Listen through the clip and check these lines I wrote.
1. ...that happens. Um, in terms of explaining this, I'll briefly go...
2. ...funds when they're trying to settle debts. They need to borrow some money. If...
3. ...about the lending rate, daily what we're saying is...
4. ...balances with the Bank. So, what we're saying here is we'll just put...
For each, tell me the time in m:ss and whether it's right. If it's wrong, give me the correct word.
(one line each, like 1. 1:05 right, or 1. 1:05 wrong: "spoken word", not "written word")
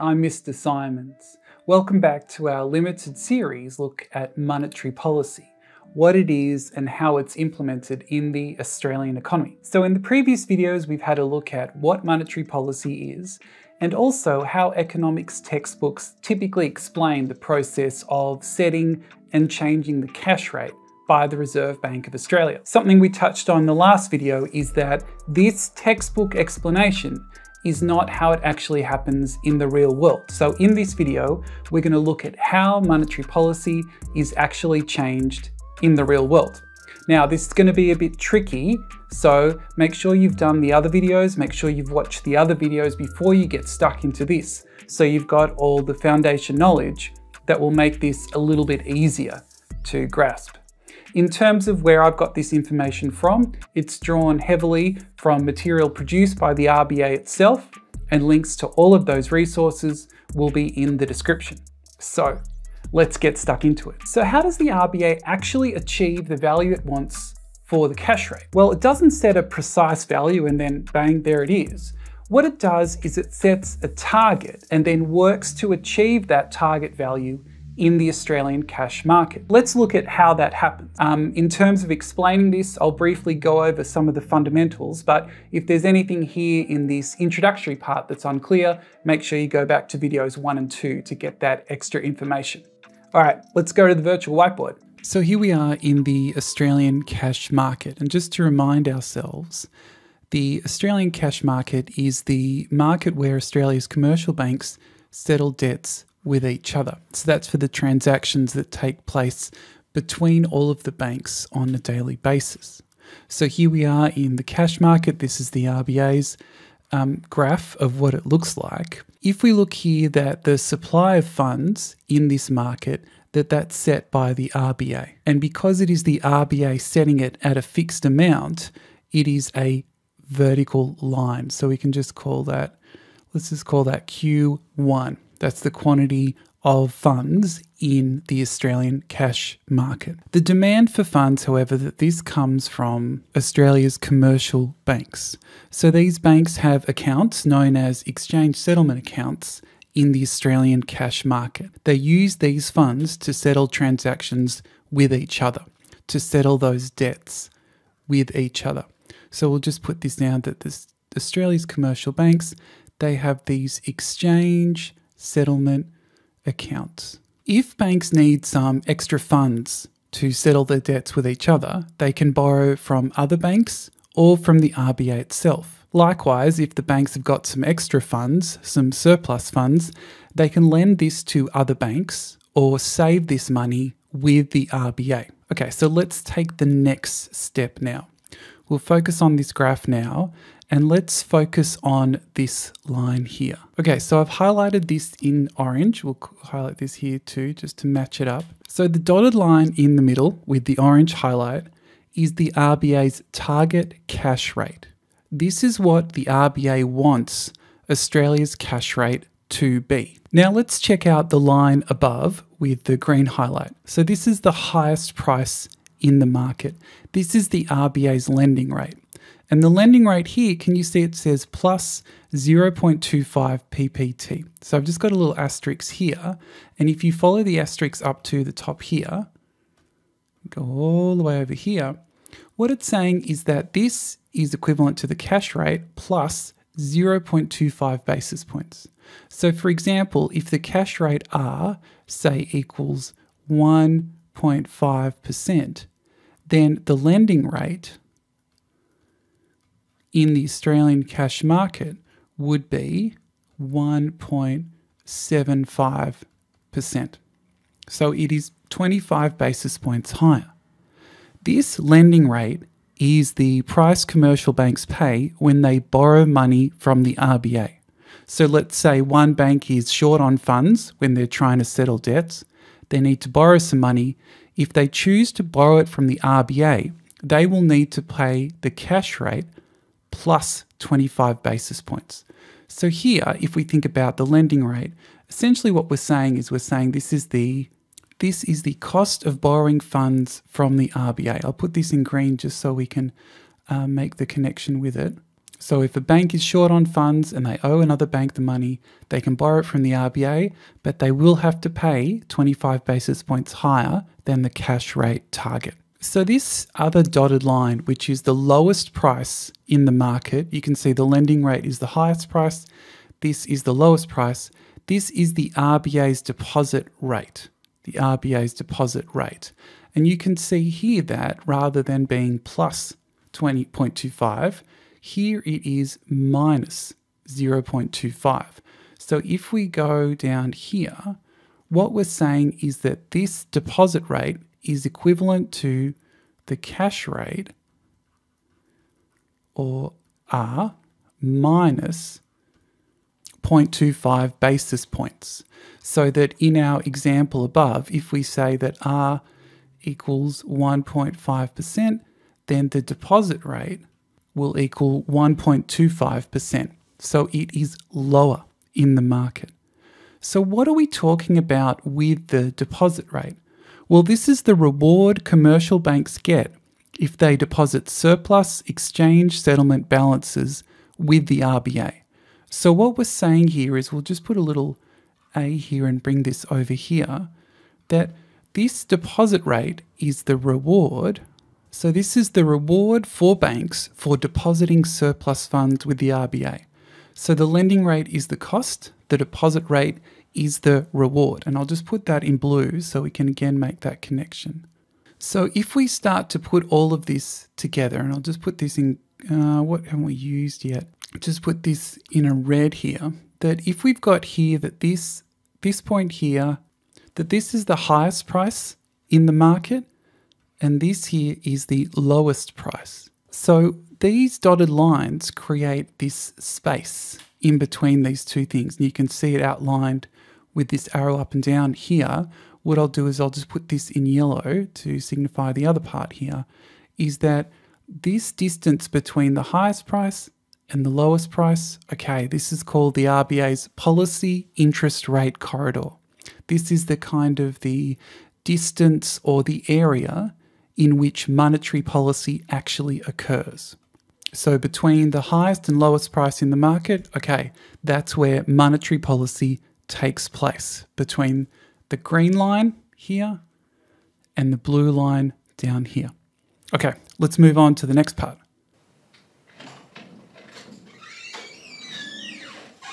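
1. 1:20 right
2. 4:30 right
3. 4:43 wrong: "essentially", not "daily"
4. 6:09 wrong: "RBA", not "Bank".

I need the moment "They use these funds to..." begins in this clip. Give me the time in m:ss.
2:31.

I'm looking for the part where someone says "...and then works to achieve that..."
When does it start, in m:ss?
1:14.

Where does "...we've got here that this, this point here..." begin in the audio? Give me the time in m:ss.
6:43.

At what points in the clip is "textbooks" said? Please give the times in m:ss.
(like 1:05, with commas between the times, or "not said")
0:15, 0:25.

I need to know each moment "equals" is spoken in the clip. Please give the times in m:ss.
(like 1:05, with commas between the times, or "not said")
4:02, 5:49, 5:54.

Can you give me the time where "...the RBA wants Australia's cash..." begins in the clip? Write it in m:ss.
3:26.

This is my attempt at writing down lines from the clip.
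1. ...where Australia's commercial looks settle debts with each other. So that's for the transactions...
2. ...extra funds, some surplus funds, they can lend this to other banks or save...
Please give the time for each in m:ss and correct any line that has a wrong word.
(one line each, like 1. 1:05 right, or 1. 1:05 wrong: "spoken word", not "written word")
1. 1:43 wrong: "banks", not "looks"
2. 2:57 right.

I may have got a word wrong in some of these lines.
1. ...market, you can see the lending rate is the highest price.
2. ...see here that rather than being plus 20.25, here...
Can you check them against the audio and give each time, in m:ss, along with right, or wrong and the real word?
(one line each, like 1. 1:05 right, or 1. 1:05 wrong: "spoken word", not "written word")
1. 5:09 right
2. 5:20 right.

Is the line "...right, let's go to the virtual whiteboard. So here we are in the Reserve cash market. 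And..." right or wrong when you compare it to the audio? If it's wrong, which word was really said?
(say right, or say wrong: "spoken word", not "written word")
wrong: "Australian", not "Reserve".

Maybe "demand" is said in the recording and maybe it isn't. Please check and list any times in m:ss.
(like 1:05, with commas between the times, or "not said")
2:20.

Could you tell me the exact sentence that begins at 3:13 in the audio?
Okay, so I've highlighted this in orange.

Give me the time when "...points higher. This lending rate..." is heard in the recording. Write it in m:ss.
4:19.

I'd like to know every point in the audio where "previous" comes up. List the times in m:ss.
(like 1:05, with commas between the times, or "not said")
0:09.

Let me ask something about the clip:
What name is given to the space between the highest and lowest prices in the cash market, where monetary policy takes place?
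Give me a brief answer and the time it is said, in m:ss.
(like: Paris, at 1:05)
Policy interest rate corridor, at 7:13.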